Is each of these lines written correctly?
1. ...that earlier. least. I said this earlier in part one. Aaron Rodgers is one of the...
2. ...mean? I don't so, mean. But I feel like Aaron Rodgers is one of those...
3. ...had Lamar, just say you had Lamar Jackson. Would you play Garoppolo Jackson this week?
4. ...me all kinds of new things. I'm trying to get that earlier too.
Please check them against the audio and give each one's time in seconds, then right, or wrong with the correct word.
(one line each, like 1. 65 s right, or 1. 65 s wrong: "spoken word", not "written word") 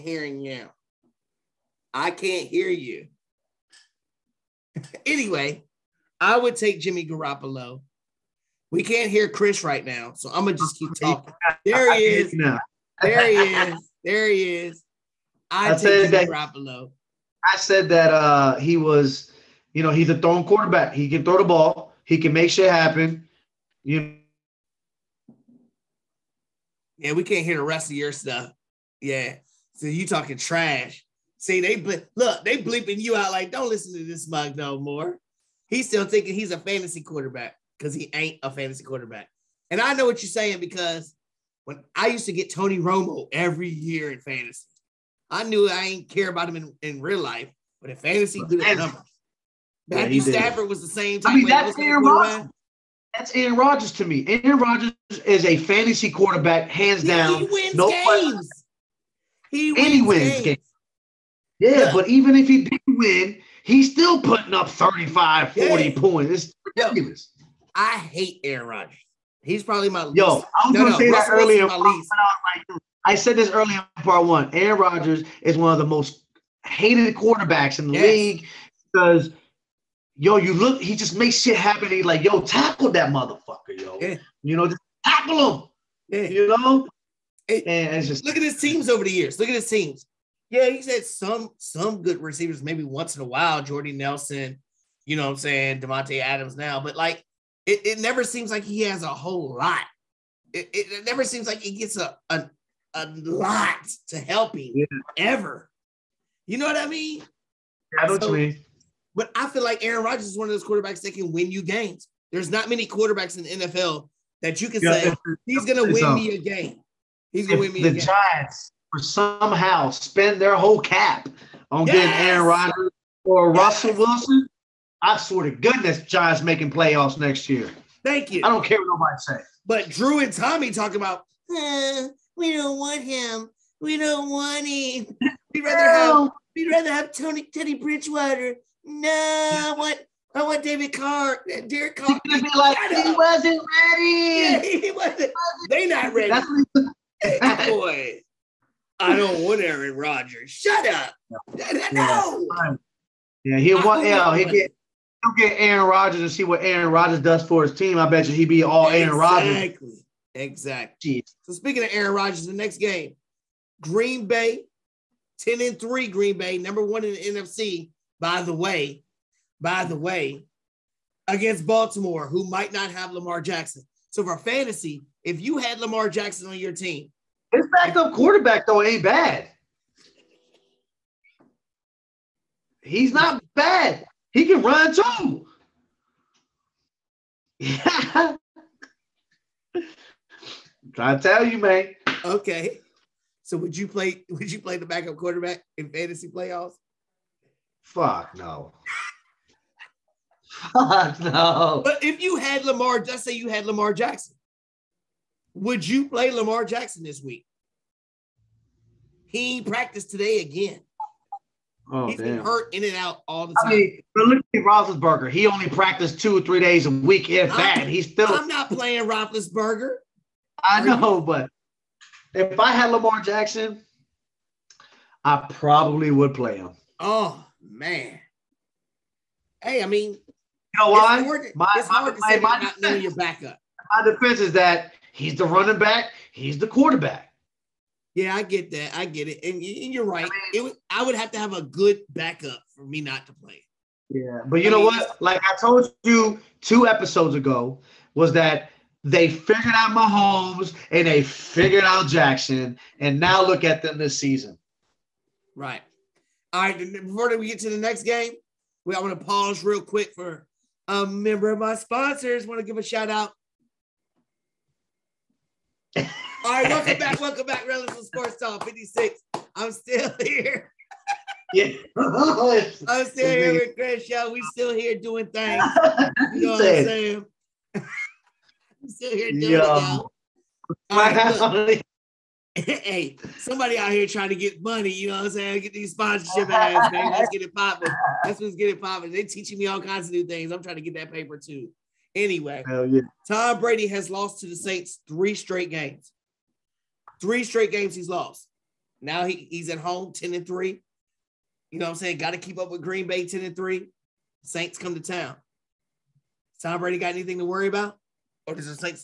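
1. 71 s right
2. 106 s right
3. 202 s wrong: "Lamar", not "Garoppolo"
4. 289 s wrong: "paper", not "earlier".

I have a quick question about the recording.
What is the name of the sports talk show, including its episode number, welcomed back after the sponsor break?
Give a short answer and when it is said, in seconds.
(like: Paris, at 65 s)
Relevance of Sports Talk 56, at 267 s.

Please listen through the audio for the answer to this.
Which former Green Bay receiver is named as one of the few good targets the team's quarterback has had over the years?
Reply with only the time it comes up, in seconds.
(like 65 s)
93 s.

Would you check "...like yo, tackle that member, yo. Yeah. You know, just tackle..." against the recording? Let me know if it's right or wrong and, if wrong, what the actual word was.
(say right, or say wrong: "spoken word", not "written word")
wrong: "motherfucker", not "member".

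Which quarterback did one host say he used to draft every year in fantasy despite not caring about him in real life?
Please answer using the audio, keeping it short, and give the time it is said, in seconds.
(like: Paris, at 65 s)
Tony Romo, at 42 s.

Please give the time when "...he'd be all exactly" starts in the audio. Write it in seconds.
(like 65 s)
158 s.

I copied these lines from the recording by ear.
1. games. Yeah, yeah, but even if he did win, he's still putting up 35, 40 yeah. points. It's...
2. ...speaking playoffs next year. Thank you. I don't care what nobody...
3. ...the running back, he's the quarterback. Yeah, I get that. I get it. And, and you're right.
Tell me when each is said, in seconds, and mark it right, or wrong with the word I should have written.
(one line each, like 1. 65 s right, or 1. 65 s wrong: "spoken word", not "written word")
1. 60 s right
2. 126 s wrong: "making", not "speaking"
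3. 235 s right.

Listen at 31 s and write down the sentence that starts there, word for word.
See, they ble- look, they bleeping you out like, don't listen to this mug no more.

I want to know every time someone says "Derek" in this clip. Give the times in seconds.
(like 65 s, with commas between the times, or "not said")
141 s.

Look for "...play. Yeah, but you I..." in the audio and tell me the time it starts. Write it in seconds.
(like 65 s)
243 s.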